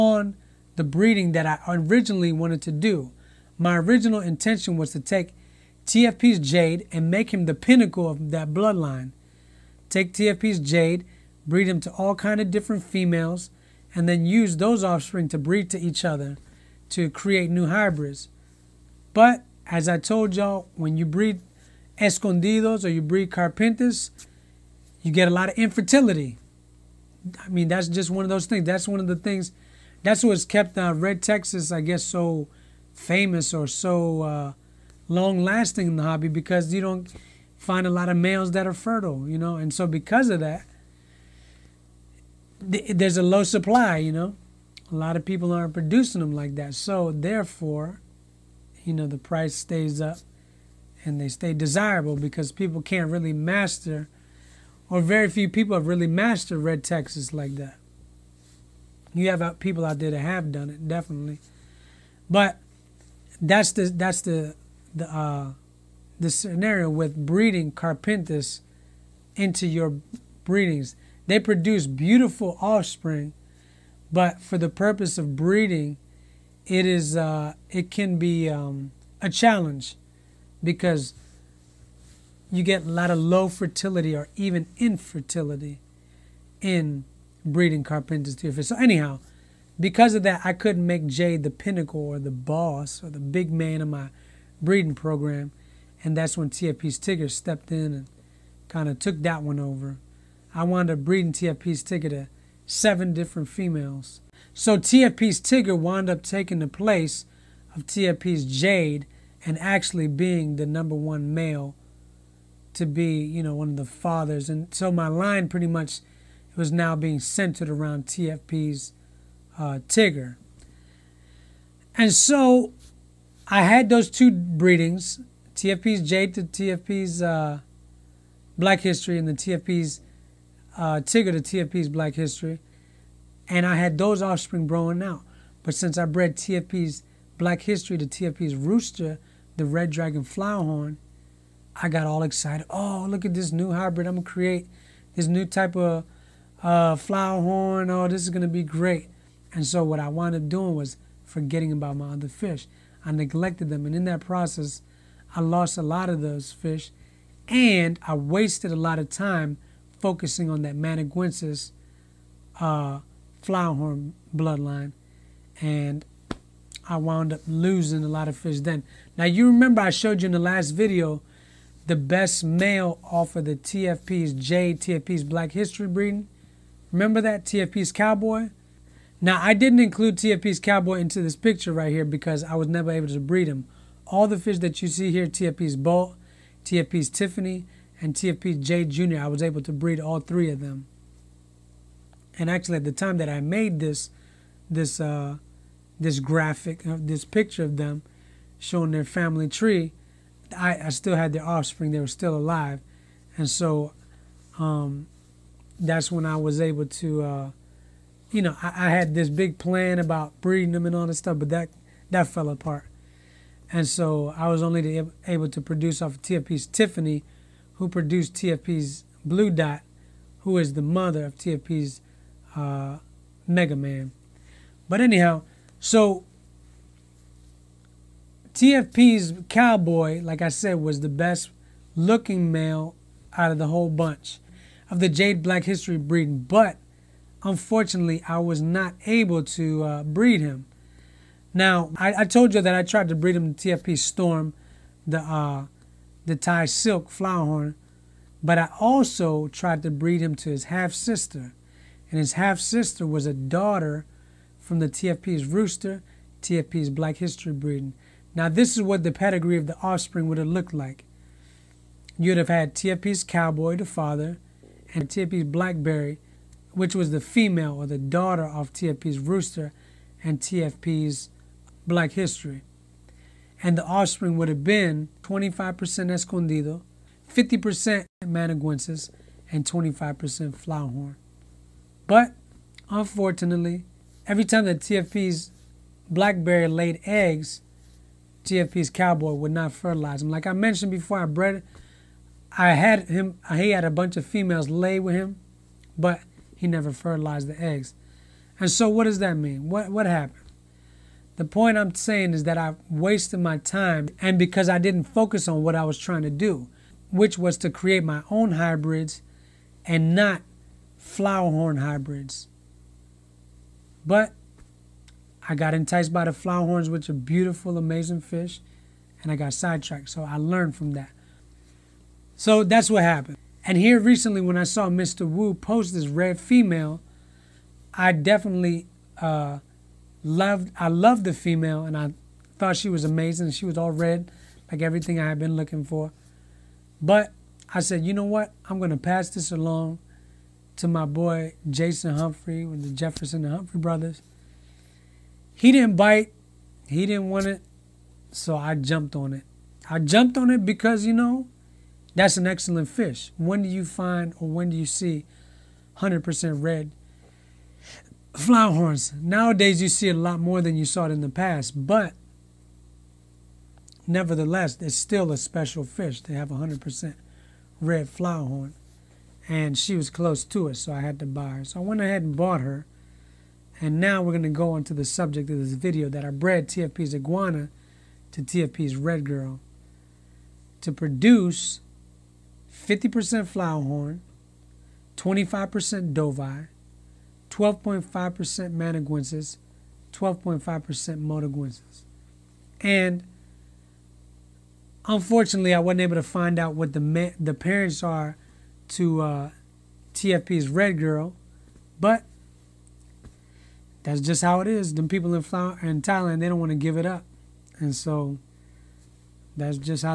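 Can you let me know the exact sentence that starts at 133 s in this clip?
And I had those offspring growing out.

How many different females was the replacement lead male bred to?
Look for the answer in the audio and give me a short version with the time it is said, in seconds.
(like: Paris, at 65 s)
7, at 102 s.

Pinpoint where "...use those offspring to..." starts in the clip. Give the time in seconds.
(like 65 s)
14 s.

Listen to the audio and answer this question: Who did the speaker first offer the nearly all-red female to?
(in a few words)
Jason Humphrey.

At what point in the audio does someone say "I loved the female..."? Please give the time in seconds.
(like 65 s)
330 s.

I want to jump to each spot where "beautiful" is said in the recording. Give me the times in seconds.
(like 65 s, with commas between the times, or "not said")
71 s, 317 s.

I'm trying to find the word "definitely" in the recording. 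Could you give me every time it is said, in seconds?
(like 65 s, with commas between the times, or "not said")
60 s, 328 s.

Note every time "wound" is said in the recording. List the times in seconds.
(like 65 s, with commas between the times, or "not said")
100 s, 105 s, 150 s, 166 s.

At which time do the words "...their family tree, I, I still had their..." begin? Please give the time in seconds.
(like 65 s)
198 s.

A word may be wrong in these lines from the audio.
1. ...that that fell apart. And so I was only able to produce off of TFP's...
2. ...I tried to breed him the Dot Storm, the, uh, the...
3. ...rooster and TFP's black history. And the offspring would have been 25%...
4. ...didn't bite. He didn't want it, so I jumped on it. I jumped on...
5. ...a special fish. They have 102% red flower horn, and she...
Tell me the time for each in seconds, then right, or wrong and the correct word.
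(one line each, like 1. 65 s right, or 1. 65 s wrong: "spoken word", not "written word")
1. 211 s right
2. 242 s wrong: "TFP", not "Dot"
3. 269 s right
4. 345 s right
5. 365 s wrong: "100", not "102".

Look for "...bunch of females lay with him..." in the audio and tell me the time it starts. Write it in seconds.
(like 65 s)
293 s.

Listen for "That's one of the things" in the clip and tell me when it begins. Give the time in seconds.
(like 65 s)
28 s.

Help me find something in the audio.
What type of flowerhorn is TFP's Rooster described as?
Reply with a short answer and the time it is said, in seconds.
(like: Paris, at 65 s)
Red Dragon, at 139 s.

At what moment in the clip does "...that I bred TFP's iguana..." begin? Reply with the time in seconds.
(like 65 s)
376 s.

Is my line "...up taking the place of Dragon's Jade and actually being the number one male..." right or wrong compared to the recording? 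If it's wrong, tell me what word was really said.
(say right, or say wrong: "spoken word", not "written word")
wrong: "TFP", not "Dragon".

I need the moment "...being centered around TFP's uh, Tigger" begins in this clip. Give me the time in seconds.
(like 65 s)
116 s.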